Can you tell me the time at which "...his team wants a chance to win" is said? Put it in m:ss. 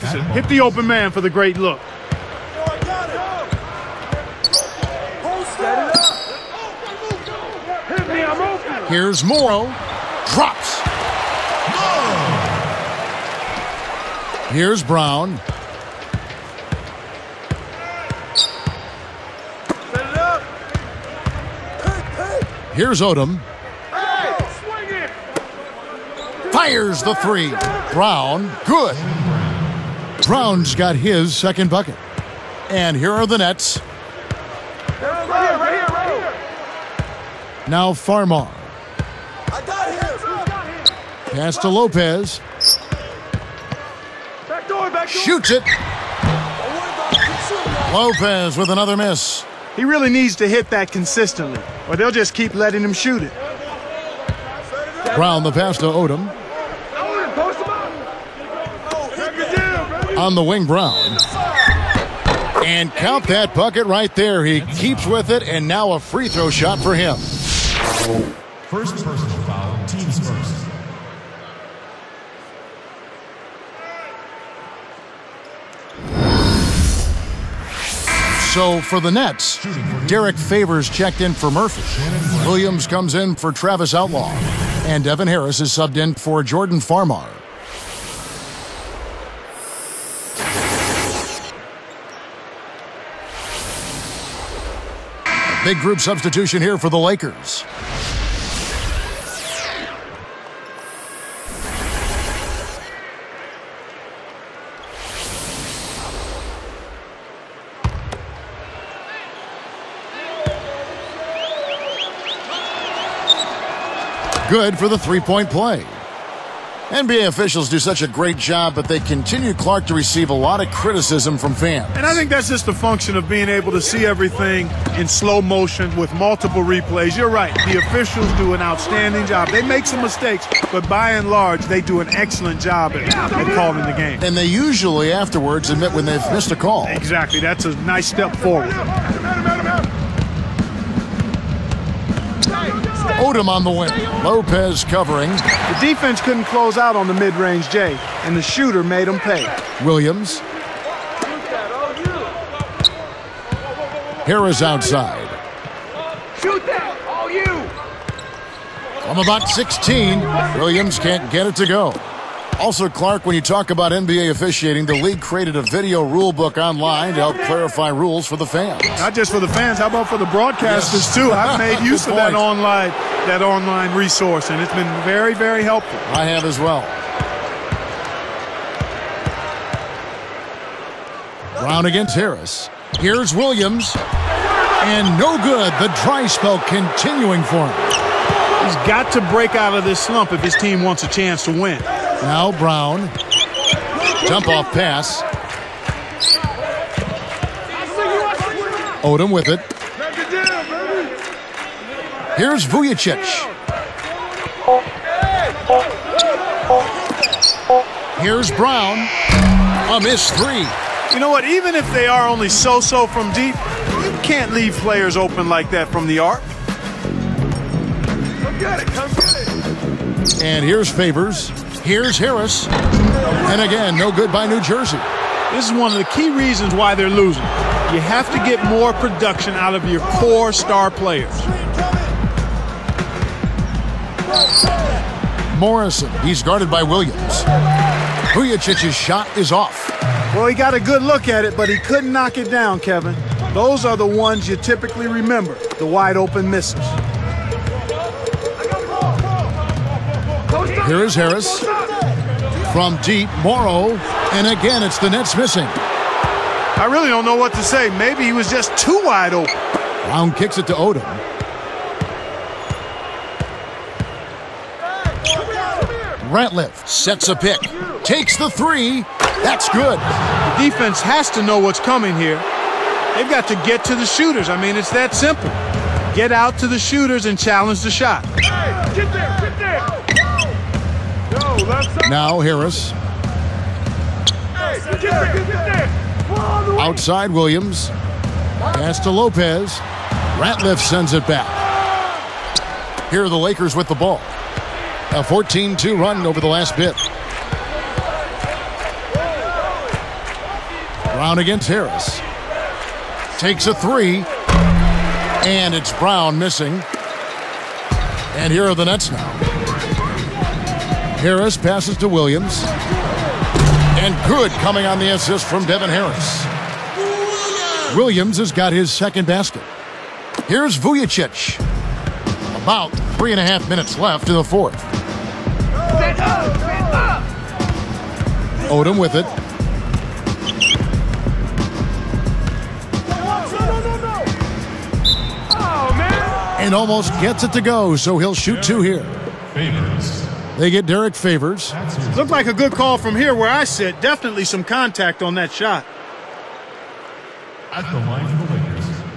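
3:10.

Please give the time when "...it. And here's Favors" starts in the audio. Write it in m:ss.
3:39.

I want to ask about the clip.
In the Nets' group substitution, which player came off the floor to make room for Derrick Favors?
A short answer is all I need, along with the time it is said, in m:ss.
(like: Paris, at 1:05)
Murphy, at 1:21.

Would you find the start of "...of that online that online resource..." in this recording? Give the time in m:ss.
2:52.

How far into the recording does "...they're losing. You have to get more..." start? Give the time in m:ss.
3:46.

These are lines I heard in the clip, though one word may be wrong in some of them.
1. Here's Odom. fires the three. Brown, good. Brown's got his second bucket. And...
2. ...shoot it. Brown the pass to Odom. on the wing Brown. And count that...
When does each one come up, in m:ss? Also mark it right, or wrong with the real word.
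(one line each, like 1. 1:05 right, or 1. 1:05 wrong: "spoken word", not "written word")
1. 0:22 right
2. 0:52 right.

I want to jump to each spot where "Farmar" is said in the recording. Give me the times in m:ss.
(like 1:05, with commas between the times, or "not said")
0:37, 1:26.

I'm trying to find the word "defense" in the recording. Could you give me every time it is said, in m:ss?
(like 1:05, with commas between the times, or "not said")
2:25, 4:30.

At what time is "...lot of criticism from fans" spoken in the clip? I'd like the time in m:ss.
2:00.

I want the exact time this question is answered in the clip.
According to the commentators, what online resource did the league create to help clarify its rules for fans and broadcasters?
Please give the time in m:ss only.
2:45.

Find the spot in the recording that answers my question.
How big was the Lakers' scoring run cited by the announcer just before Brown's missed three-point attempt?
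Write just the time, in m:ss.
4:55.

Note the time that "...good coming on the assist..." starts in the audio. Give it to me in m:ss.
5:14.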